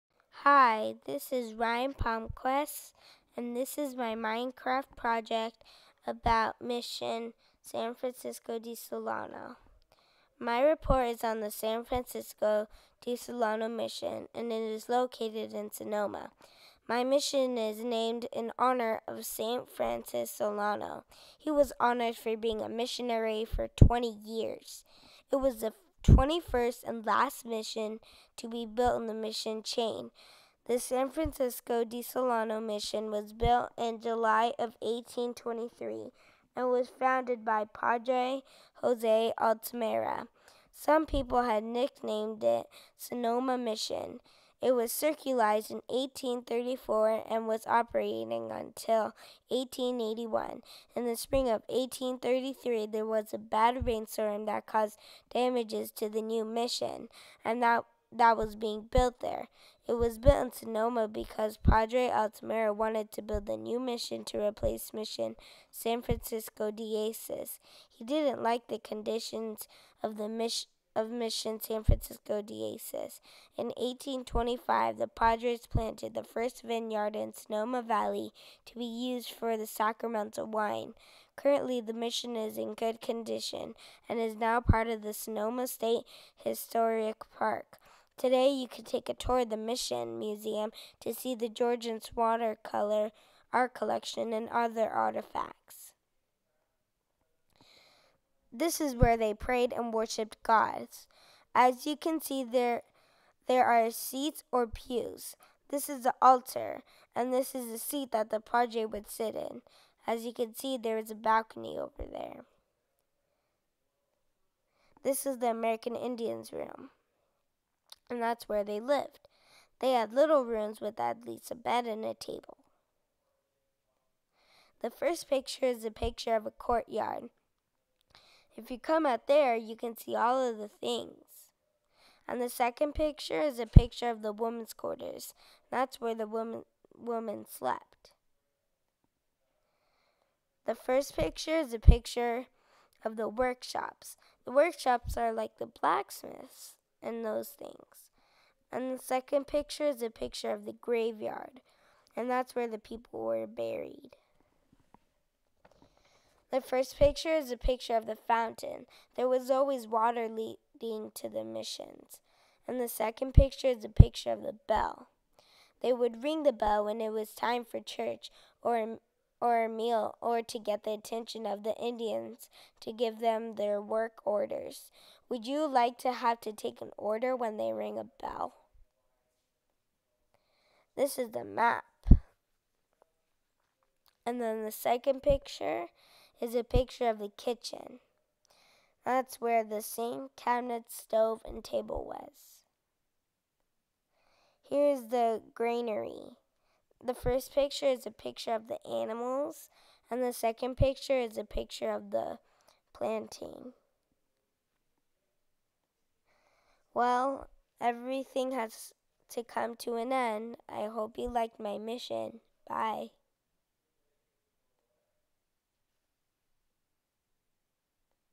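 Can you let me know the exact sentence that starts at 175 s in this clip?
Would you like to have to take an order when they ring a bell?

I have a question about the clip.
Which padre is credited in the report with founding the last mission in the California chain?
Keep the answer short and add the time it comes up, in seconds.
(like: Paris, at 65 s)
Padre Jose Altamira, at 37 s.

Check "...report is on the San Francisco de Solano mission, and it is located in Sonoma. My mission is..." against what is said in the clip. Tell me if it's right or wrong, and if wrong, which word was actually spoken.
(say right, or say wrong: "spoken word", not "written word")
right.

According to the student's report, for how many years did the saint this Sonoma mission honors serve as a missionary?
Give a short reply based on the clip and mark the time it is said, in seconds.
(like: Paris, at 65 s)
20, at 23 s.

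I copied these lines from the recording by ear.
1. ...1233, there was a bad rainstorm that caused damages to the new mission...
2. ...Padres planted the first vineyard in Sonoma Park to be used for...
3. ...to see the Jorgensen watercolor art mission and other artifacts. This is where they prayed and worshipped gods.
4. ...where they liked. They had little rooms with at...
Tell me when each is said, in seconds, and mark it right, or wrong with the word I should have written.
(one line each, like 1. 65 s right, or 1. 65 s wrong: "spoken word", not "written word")
1. 51 s wrong: "1833", not "1233"
2. 75 s wrong: "Valley", not "Park"
3. 90 s wrong: "collection", not "mission"
4. 118 s wrong: "lived", not "liked".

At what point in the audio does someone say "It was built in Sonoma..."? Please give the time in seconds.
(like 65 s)
59 s.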